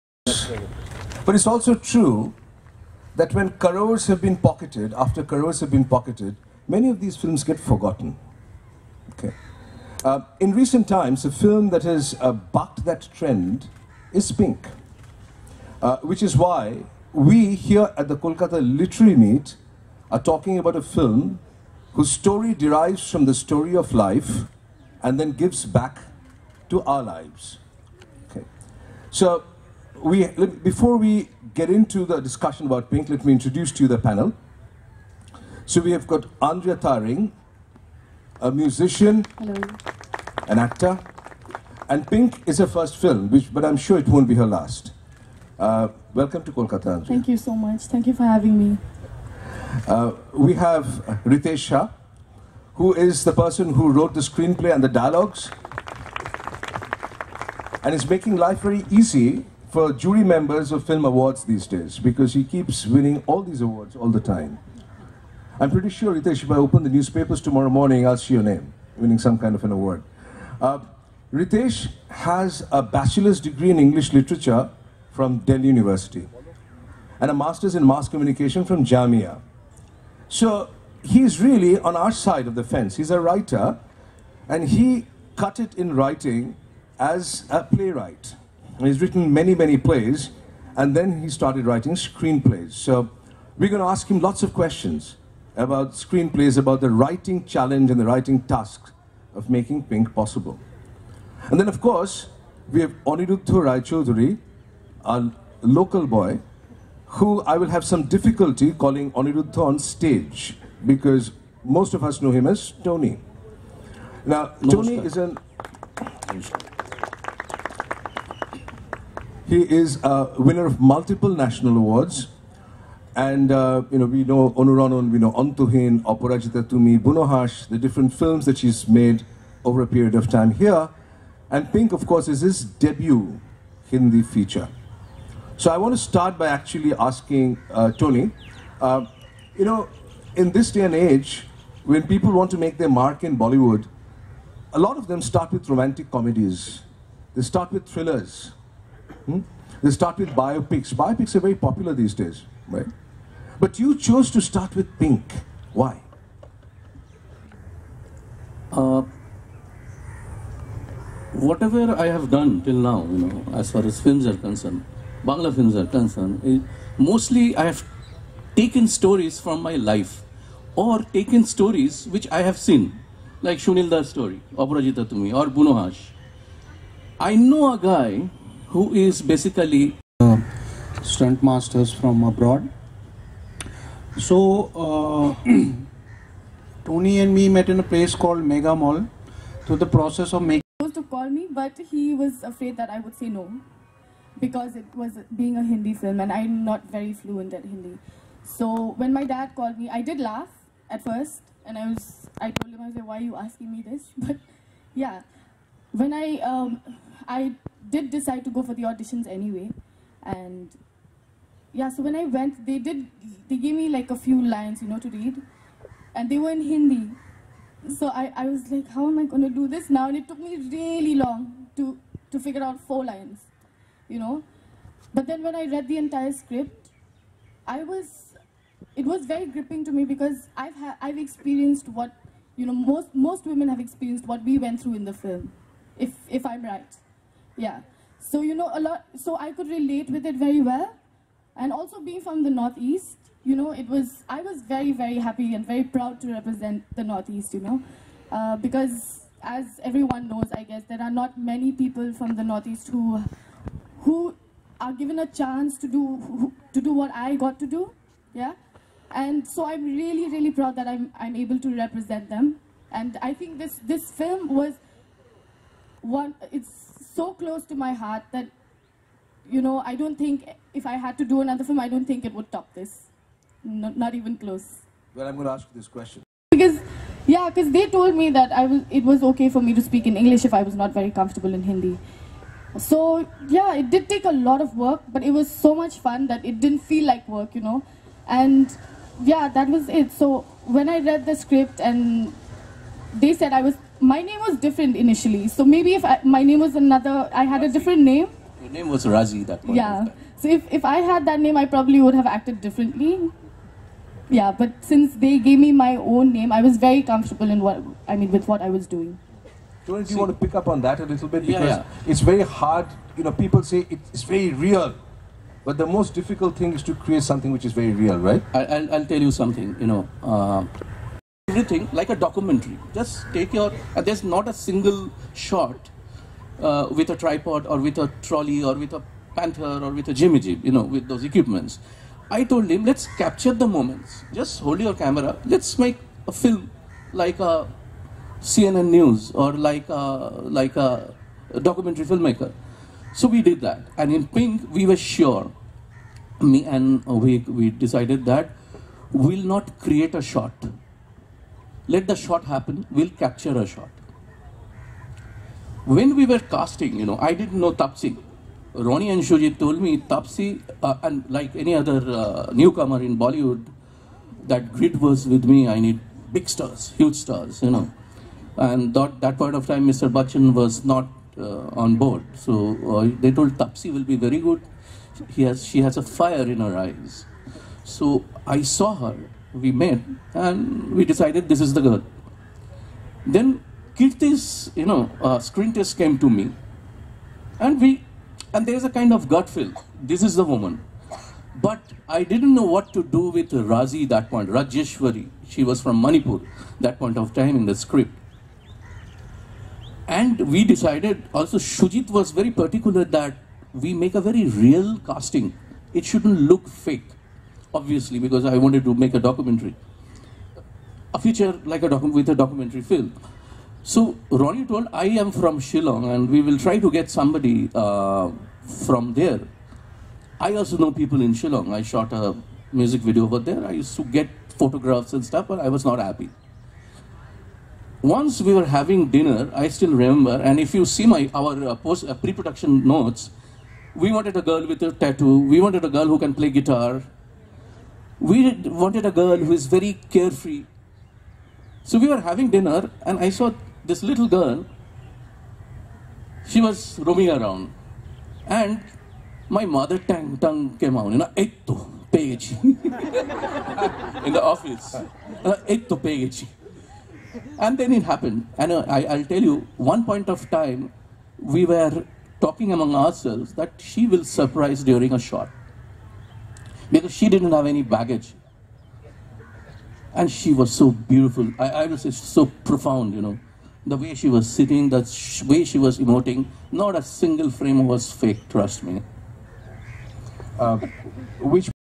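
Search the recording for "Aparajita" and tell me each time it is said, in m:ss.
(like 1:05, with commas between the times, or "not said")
2:06, 2:54.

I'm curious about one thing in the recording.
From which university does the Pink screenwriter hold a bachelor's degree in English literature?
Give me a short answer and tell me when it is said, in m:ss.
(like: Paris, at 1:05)
Delhi University, at 1:15.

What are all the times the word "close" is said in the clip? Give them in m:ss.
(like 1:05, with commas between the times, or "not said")
4:27, 4:34.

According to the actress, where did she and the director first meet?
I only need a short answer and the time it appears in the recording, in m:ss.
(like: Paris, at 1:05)
Mega Mall, at 3:08.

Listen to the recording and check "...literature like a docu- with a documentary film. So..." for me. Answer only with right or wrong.
wrong.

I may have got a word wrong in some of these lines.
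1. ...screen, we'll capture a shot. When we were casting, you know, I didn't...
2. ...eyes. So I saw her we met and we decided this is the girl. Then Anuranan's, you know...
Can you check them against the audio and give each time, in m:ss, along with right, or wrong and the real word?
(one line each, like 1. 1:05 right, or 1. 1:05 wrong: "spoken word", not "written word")
1. 5:52 wrong: "happen", not "screen"
2. 6:16 wrong: "Kirti", not "Anuranan".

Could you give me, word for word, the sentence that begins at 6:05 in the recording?
I need big stars, huge stars, you know.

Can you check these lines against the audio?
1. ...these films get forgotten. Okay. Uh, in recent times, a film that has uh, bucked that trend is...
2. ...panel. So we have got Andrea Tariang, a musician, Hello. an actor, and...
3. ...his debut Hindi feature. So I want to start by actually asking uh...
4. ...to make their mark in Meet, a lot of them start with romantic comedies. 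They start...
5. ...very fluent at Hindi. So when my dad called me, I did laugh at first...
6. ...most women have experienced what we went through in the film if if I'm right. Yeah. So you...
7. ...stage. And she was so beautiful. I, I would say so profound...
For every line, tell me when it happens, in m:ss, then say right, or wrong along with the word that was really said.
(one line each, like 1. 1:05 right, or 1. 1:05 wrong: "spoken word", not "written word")
1. 0:06 right
2. 0:33 right
3. 2:12 right
4. 2:22 wrong: "Bollywood", not "Meet"
5. 3:16 right
6. 3:53 right
7. 7:47 wrong: "baggage", not "stage".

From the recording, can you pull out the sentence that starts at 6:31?
But I didn't know what to do with Razi that point, Rajeshwari.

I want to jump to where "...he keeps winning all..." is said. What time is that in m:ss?
1:02.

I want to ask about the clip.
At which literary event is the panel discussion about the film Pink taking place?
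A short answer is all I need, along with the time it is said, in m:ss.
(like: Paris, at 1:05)
Kolkata Literary Meet, at 0:18.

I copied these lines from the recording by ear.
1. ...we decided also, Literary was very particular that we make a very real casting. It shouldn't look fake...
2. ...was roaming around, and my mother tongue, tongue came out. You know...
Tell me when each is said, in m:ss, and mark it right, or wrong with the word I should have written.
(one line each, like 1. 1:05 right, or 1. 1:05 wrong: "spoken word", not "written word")
1. 6:40 wrong: "Shoojit", not "Literary"
2. 7:26 right.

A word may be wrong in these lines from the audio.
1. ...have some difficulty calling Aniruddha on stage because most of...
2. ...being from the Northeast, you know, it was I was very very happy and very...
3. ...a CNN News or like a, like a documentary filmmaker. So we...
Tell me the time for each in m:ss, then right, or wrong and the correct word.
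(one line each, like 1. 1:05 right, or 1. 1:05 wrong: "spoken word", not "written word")
1. 1:47 right
2. 4:01 right
3. 5:37 right.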